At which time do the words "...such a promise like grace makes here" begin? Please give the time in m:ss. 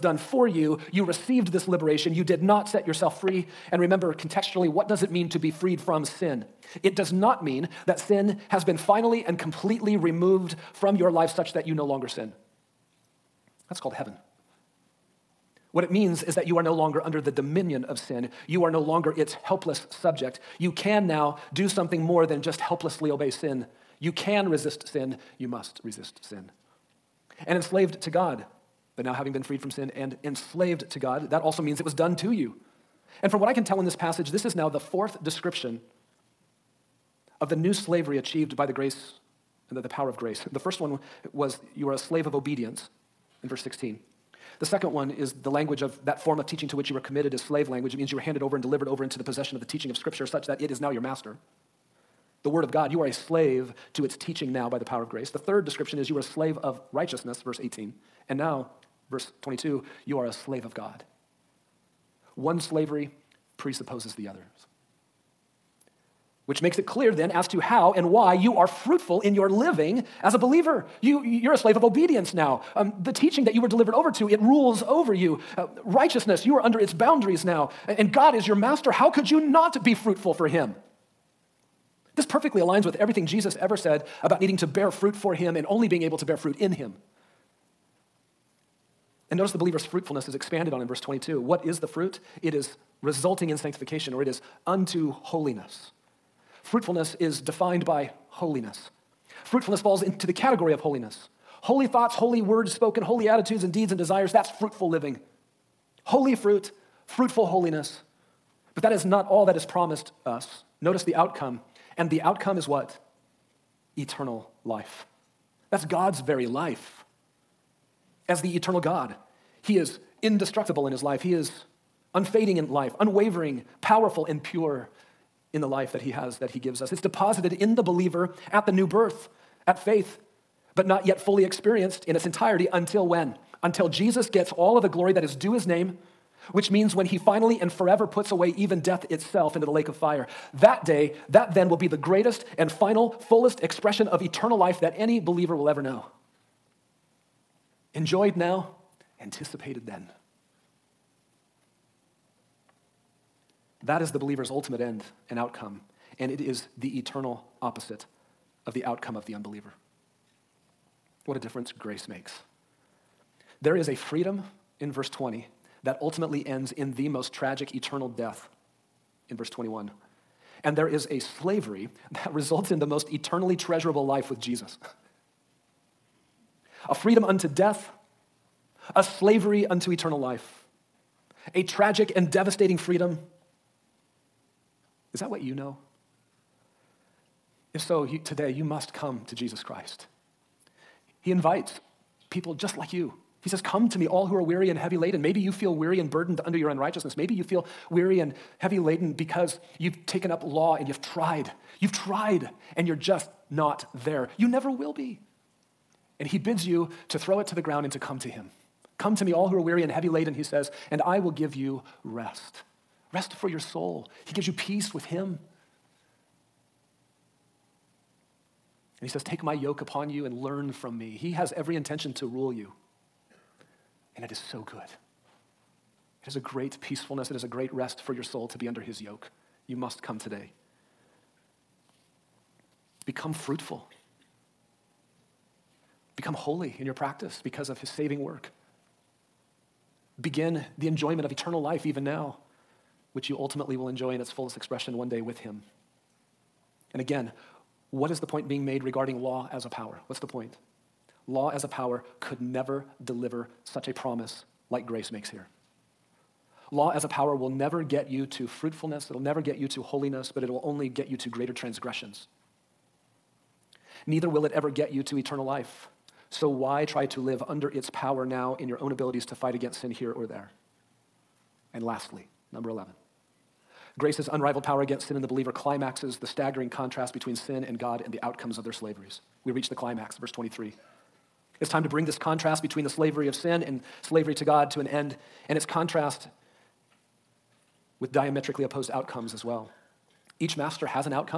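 4:13.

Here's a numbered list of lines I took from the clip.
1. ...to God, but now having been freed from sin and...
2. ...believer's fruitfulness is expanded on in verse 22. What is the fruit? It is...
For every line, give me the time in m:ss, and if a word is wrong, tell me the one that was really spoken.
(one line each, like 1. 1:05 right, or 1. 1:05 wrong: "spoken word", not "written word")
1. 0:28 right
2. 1:29 right.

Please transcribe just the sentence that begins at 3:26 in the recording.
And he bids you to throw it to the ground and to come to him.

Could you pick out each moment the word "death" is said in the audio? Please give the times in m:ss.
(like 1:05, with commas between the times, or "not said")
2:18, 2:48, 2:57.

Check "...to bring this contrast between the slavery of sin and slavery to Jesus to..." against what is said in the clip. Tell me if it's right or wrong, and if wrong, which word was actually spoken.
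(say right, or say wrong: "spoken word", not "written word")
wrong: "God", not "Jesus".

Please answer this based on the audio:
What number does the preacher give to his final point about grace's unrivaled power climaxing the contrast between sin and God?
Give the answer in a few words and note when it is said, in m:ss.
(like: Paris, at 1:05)
11, at 4:32.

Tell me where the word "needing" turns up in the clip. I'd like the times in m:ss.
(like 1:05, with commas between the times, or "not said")
1:24.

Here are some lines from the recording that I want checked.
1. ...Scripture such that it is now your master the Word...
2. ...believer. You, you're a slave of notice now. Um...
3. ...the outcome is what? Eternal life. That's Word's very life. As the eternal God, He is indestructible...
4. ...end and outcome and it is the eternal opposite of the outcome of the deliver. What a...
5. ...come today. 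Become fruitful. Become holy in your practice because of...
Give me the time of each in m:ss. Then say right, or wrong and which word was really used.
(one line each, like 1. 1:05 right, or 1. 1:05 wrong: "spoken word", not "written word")
1. 0:49 right
2. 1:10 wrong: "obedience", not "notice"
3. 1:52 wrong: "God", not "Word"
4. 2:34 wrong: "unbeliever", not "deliver"
5. 3:50 right.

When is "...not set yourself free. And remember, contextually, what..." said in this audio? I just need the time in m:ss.
0:02.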